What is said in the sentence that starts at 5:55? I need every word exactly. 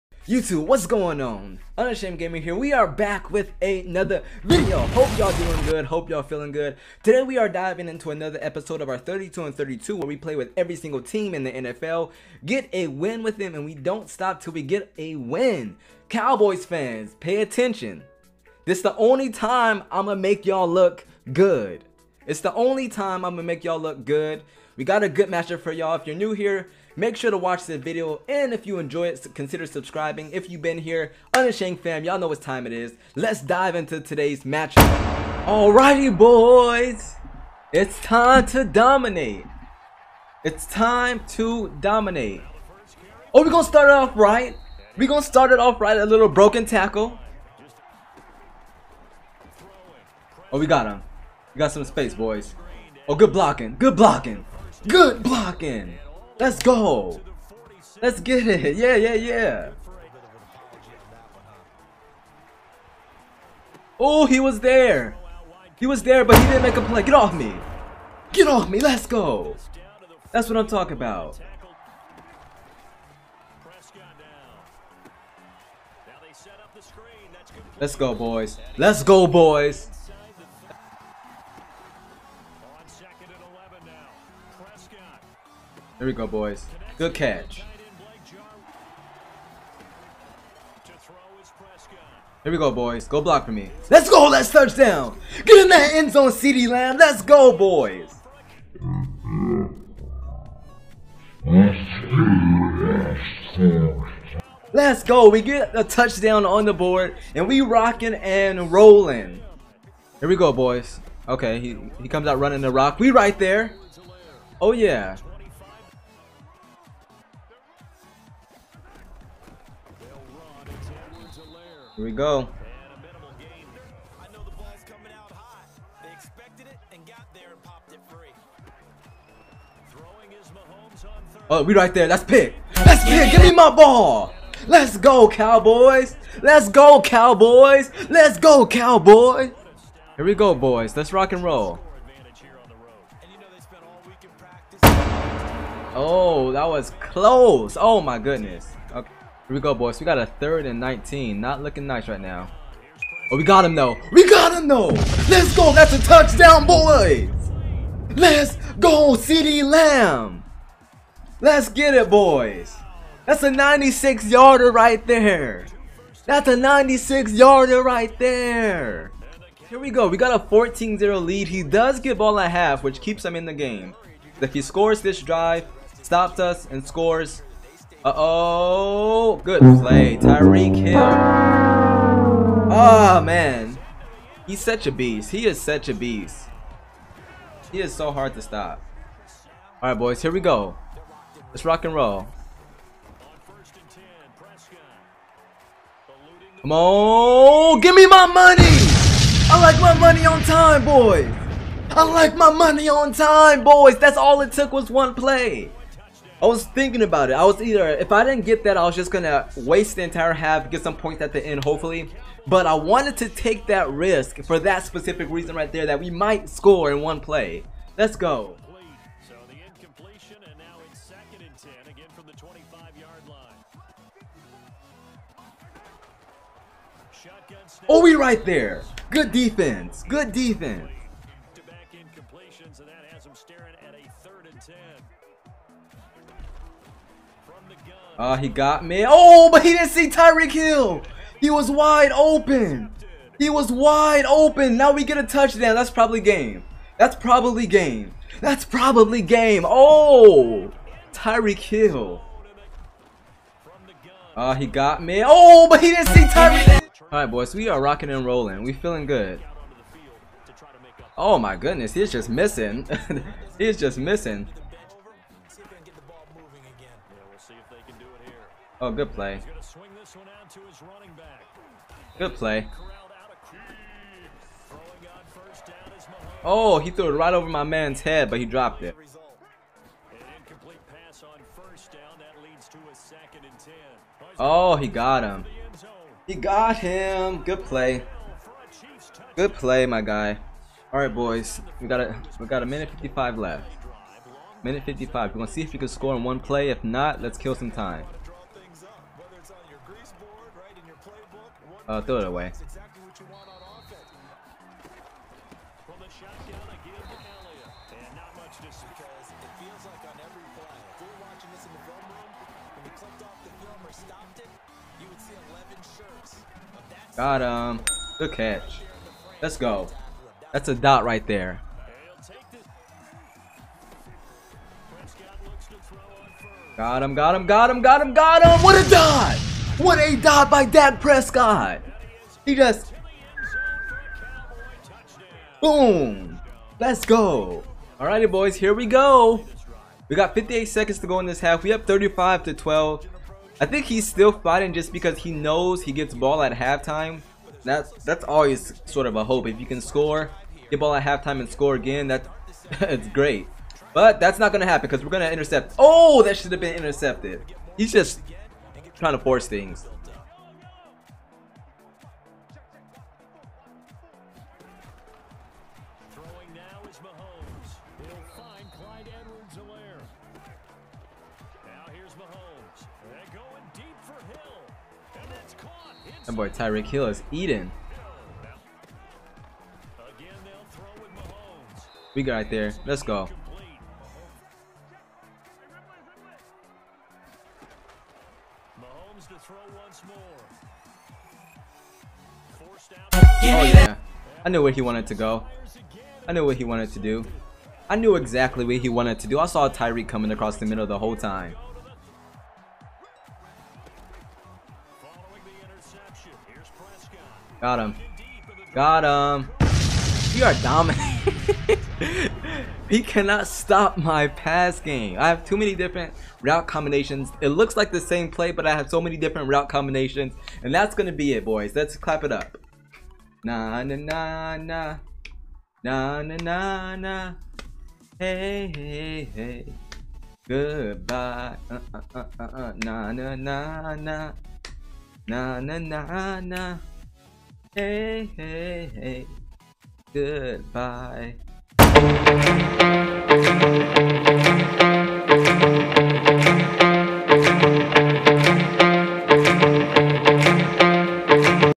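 Oh, that should have been intercepted.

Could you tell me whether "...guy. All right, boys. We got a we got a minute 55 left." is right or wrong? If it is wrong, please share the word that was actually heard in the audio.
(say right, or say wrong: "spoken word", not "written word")
right.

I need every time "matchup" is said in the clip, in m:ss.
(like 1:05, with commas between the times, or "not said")
0:25, 0:34.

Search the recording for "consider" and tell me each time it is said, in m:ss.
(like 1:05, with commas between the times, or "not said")
0:29.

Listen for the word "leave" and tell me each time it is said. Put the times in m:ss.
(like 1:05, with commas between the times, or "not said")
not said.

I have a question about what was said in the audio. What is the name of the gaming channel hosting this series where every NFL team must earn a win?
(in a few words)
Unashamed Gaming.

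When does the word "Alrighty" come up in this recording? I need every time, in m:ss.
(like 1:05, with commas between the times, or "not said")
0:35, 5:37.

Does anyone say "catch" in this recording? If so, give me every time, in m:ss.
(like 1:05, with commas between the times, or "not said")
1:27, 5:18.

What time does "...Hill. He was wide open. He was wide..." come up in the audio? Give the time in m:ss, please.
4:00.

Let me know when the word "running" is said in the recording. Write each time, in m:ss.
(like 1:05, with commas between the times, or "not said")
1:52.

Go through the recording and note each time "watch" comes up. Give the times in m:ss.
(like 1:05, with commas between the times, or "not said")
0:27.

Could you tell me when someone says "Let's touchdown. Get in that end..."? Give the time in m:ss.
1:34.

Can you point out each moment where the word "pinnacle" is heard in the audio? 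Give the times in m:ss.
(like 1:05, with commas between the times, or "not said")
not said.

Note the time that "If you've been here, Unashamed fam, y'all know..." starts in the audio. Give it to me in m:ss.
0:30.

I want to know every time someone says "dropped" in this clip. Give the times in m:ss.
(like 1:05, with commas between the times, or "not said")
4:38.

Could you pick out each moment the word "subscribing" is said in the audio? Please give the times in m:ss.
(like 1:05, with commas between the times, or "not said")
0:29.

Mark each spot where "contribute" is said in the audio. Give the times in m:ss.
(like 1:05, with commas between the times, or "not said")
not said.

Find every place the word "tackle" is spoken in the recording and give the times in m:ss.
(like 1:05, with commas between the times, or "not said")
0:46.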